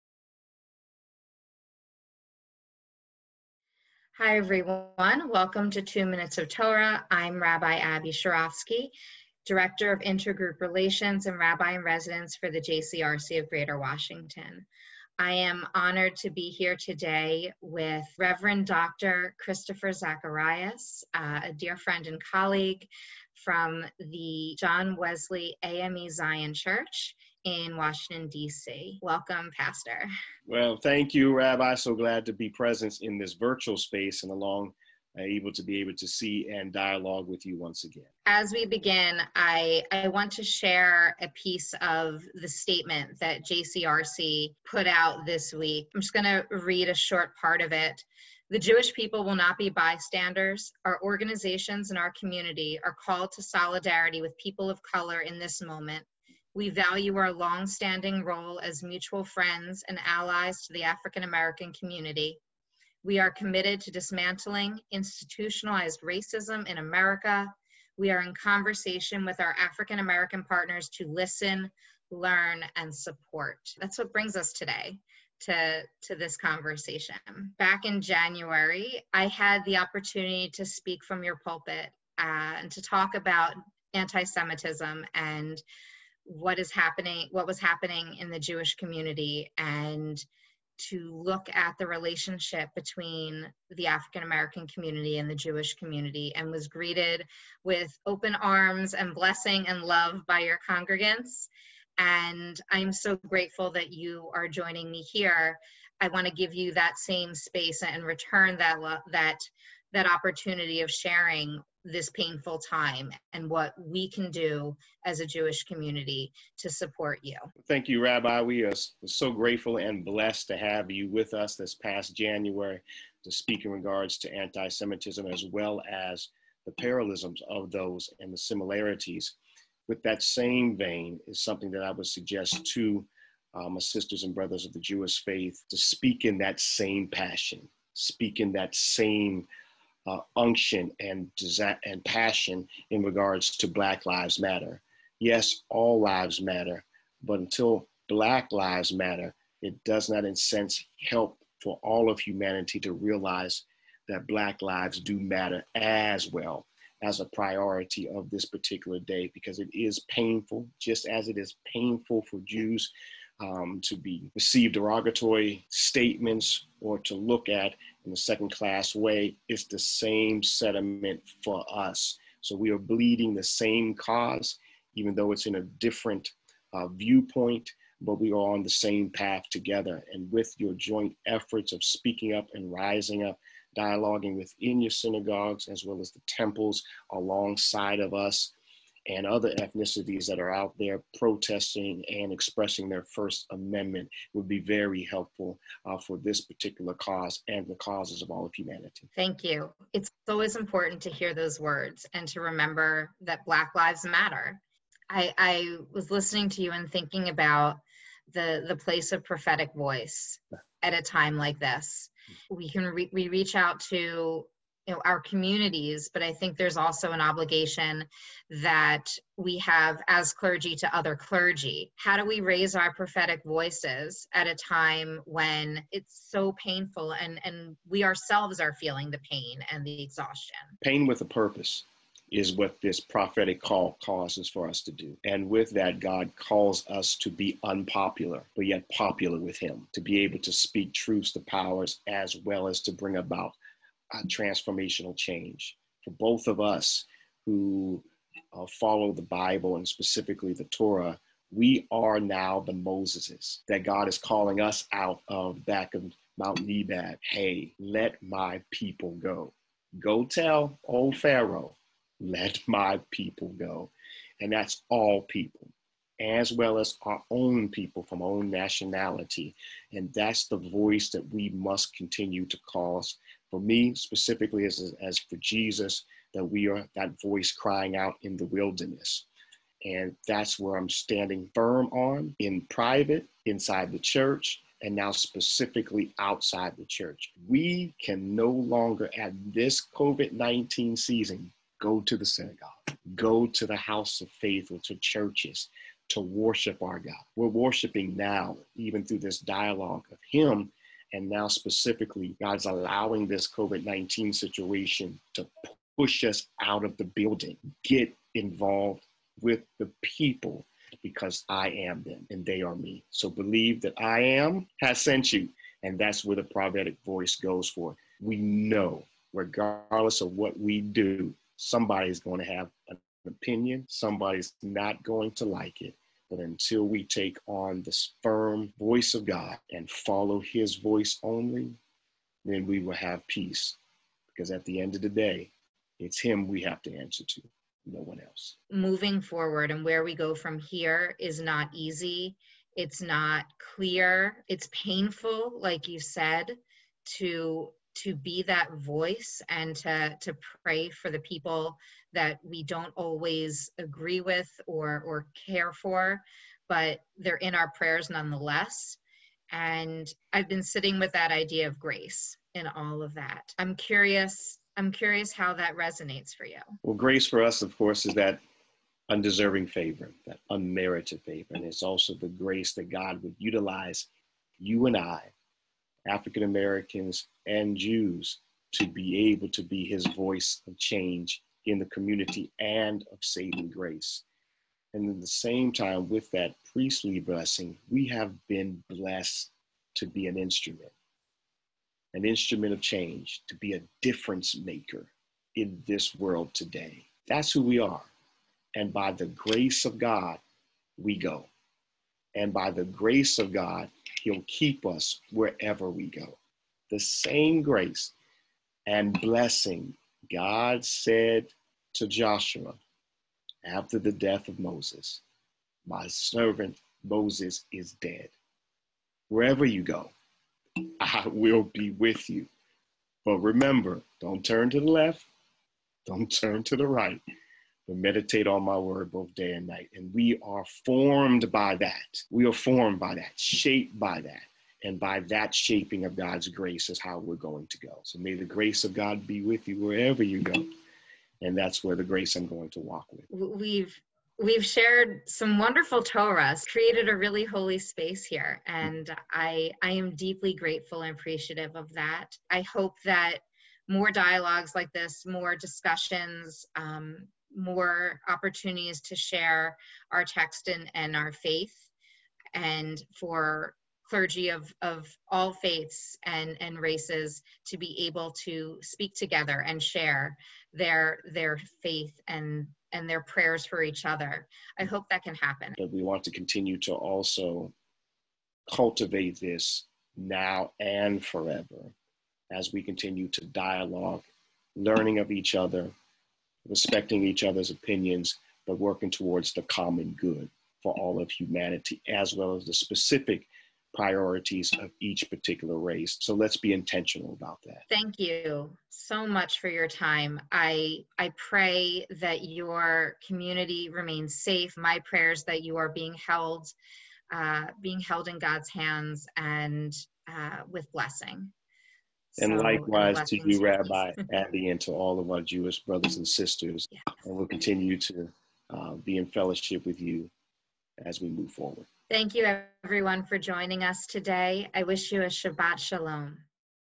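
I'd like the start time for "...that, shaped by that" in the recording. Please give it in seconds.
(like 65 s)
433 s.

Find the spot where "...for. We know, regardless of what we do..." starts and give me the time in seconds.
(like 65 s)
317 s.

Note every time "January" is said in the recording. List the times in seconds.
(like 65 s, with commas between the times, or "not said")
78 s, 122 s.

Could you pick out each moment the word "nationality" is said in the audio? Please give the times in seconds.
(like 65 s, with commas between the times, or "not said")
268 s.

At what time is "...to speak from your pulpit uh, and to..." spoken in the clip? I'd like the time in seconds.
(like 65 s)
80 s.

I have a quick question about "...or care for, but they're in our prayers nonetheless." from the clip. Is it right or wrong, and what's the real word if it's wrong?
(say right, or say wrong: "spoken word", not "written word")
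right.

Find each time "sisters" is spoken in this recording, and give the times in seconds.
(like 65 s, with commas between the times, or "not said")
133 s, 516 s.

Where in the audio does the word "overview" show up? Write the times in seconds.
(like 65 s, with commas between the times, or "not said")
not said.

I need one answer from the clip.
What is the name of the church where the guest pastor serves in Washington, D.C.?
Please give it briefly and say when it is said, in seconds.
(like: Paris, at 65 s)
John Wesley AME Zion Church, at 24 s.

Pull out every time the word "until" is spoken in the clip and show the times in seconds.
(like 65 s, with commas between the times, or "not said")
147 s, 326 s.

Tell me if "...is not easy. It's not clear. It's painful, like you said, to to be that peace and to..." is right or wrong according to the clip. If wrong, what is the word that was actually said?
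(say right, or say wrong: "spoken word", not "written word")
wrong: "voice", not "peace".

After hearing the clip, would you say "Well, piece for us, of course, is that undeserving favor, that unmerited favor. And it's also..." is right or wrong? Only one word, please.
wrong.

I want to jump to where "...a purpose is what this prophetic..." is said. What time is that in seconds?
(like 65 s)
231 s.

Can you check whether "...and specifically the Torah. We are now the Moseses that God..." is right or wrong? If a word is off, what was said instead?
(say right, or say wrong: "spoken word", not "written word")
right.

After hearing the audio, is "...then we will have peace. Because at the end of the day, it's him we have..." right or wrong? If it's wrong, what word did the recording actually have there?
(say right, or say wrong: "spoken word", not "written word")
right.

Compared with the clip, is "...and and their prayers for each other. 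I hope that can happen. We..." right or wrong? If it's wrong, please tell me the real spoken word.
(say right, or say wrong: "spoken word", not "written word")
right.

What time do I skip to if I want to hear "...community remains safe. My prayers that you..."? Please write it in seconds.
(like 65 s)
503 s.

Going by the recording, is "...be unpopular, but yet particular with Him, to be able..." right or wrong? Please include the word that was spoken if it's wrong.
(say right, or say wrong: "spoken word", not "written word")
wrong: "popular", not "particular".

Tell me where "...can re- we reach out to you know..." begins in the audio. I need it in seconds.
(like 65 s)
212 s.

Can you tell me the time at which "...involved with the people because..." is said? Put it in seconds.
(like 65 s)
308 s.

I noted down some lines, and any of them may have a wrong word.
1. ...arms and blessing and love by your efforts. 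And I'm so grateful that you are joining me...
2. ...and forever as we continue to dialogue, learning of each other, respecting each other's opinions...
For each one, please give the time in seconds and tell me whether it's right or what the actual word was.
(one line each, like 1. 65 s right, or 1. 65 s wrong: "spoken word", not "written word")
1. 98 s wrong: "congregants", not "efforts"
2. 480 s right.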